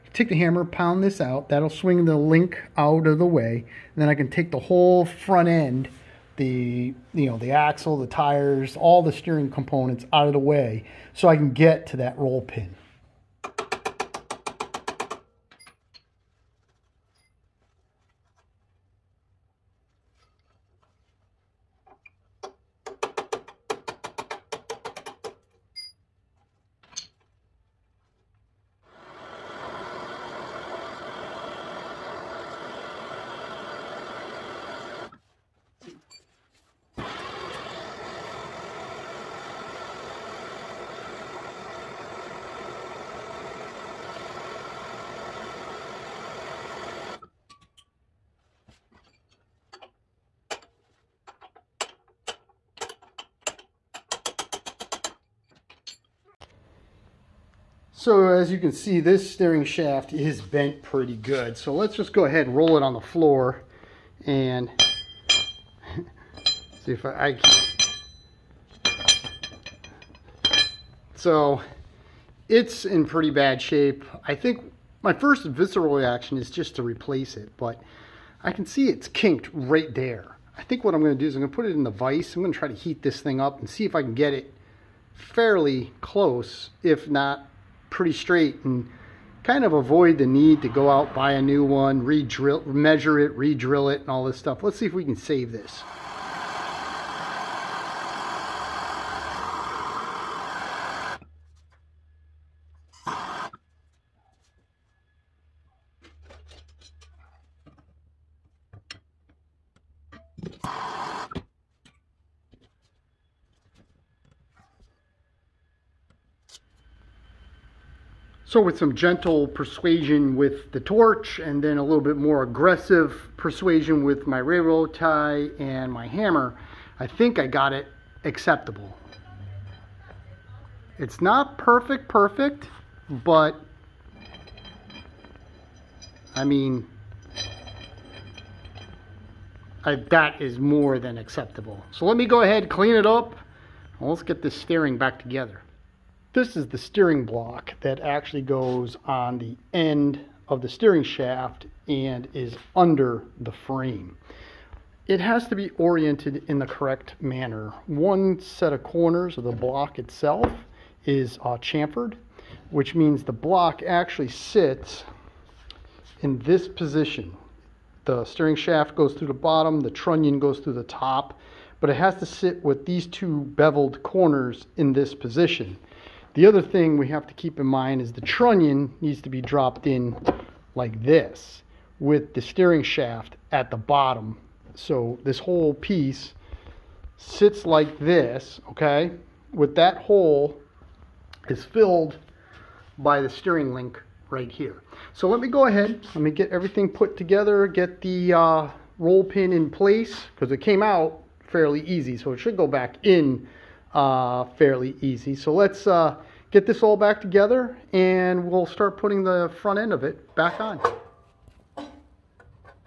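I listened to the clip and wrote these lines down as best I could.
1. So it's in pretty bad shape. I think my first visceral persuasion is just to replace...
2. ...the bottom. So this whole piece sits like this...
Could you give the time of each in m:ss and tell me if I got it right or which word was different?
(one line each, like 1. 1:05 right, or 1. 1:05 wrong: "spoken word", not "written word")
1. 1:11 wrong: "reaction", not "persuasion"
2. 3:03 right.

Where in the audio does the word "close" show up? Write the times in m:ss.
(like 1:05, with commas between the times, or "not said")
1:26.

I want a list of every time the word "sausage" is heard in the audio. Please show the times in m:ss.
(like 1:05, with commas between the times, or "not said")
not said.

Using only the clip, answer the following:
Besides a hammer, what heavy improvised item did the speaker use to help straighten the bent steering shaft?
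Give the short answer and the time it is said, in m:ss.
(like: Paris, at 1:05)
railroad tie, at 2:04.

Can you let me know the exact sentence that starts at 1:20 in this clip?
I think what I'm gonna do is I'm gonna put it in the vise.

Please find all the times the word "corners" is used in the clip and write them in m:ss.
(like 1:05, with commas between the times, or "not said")
2:38, 2:54.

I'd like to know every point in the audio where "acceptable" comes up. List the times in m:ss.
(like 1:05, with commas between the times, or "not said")
2:08, 2:21.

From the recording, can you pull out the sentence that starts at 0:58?
So as you can see, this steering shaft is bent pretty good.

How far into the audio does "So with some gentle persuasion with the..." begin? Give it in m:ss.
1:58.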